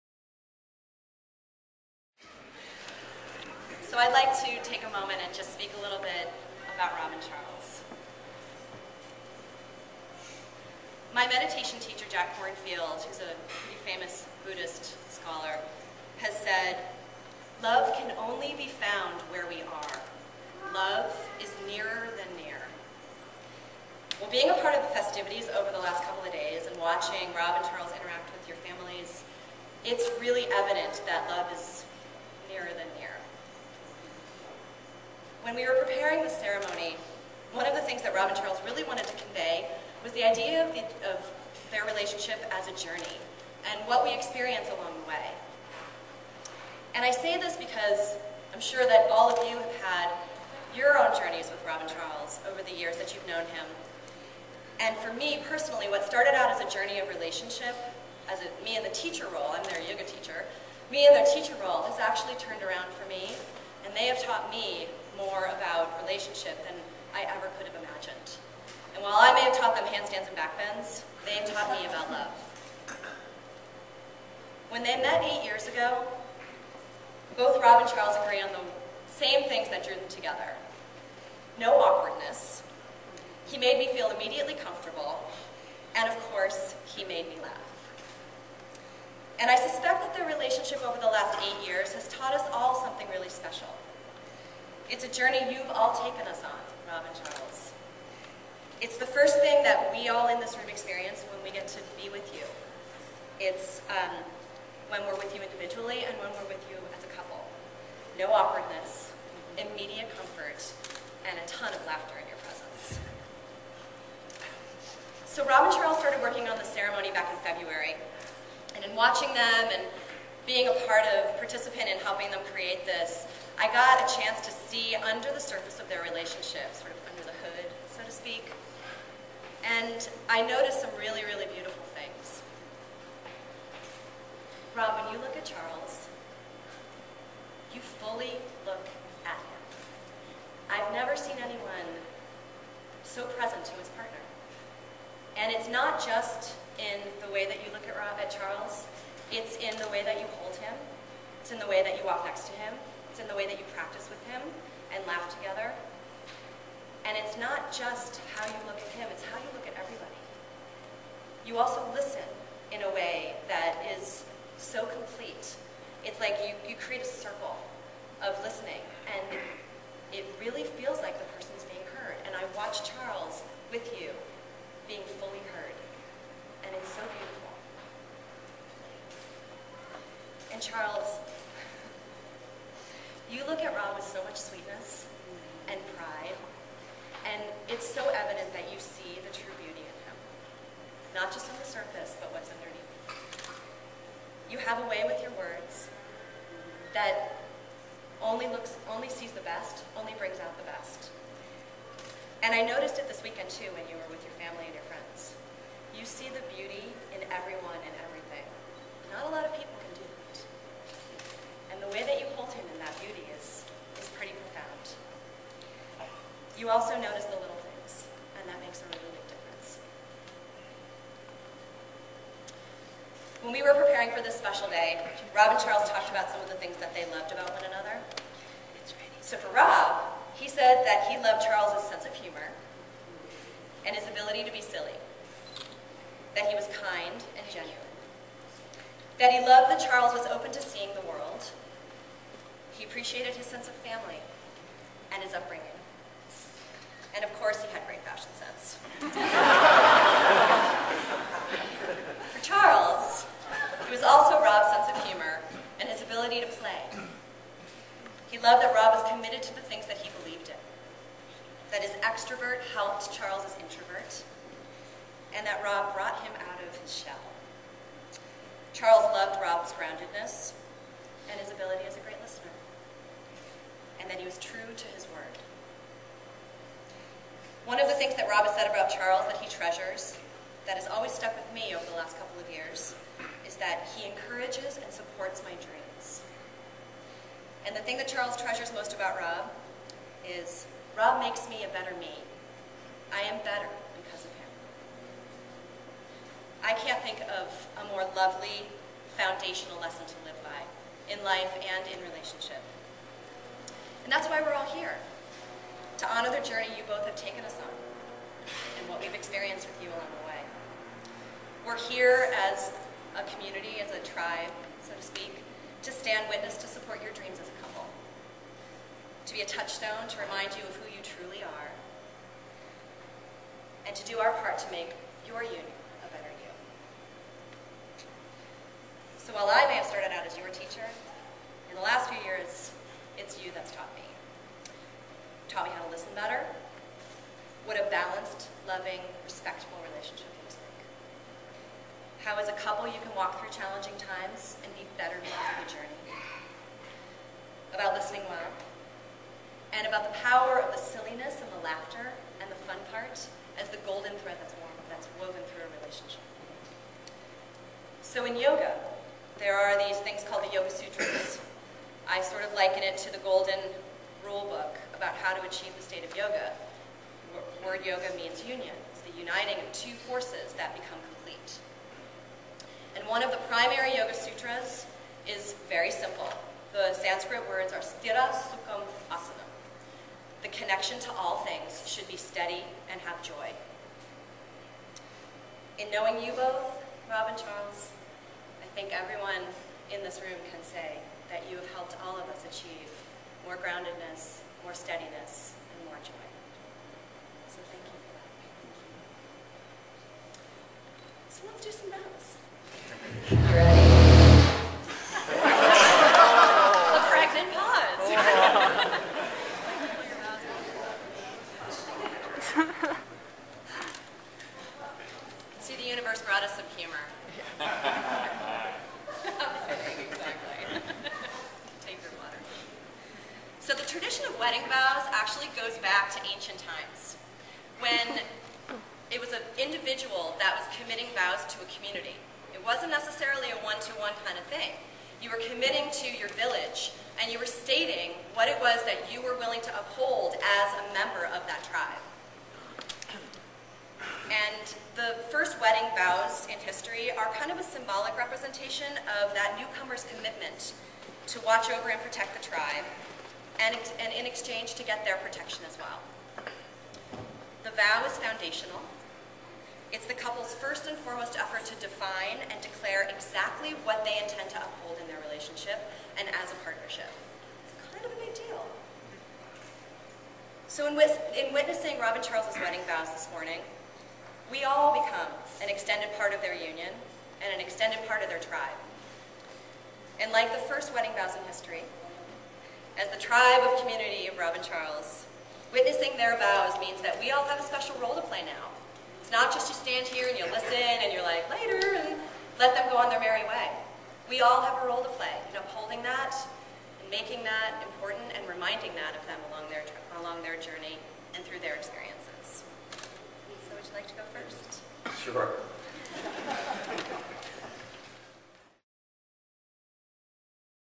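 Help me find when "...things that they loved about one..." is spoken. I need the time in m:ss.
3:46.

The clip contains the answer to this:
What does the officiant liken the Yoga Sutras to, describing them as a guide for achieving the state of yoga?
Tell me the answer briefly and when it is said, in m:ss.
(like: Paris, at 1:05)
golden rule book, at 6:03.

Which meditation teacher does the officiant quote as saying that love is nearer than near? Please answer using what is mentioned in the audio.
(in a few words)
Jack Kornfield.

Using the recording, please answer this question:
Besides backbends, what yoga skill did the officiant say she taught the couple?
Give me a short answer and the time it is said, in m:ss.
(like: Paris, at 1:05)
handstands, at 1:09.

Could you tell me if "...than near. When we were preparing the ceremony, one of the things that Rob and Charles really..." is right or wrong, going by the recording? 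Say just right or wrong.
right.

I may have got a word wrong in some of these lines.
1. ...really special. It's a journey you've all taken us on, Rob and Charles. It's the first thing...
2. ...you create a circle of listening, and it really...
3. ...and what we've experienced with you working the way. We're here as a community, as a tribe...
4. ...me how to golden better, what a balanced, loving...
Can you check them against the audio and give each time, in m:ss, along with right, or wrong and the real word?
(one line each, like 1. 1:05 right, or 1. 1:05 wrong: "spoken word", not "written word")
1. 1:33 right
2. 2:46 right
3. 5:08 wrong: "along", not "working"
4. 5:35 wrong: "listen", not "golden".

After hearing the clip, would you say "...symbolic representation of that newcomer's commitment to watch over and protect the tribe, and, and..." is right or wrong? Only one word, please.
right.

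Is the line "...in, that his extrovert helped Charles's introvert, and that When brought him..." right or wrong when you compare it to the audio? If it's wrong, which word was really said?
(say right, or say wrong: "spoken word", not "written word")
wrong: "Rob", not "When".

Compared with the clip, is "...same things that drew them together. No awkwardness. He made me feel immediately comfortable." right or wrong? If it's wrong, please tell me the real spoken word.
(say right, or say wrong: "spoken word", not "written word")
right.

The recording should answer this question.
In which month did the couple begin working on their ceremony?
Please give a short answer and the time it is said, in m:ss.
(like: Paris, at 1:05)
February, at 1:57.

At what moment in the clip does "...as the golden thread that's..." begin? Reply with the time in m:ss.
5:53.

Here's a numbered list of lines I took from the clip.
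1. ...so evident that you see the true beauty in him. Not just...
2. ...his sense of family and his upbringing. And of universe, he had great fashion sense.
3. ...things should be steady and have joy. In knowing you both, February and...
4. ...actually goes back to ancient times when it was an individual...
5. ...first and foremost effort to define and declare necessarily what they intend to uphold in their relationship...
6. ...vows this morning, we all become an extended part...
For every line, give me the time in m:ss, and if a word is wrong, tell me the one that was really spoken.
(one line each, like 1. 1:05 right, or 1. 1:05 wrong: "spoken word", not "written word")
1. 3:07 right
2. 4:03 wrong: "course", not "universe"
3. 6:21 wrong: "Rob", not "February"
4. 7:05 right
5. 7:40 wrong: "exactly", not "necessarily"
6. 7:52 right.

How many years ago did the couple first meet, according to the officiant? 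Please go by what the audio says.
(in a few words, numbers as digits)
8.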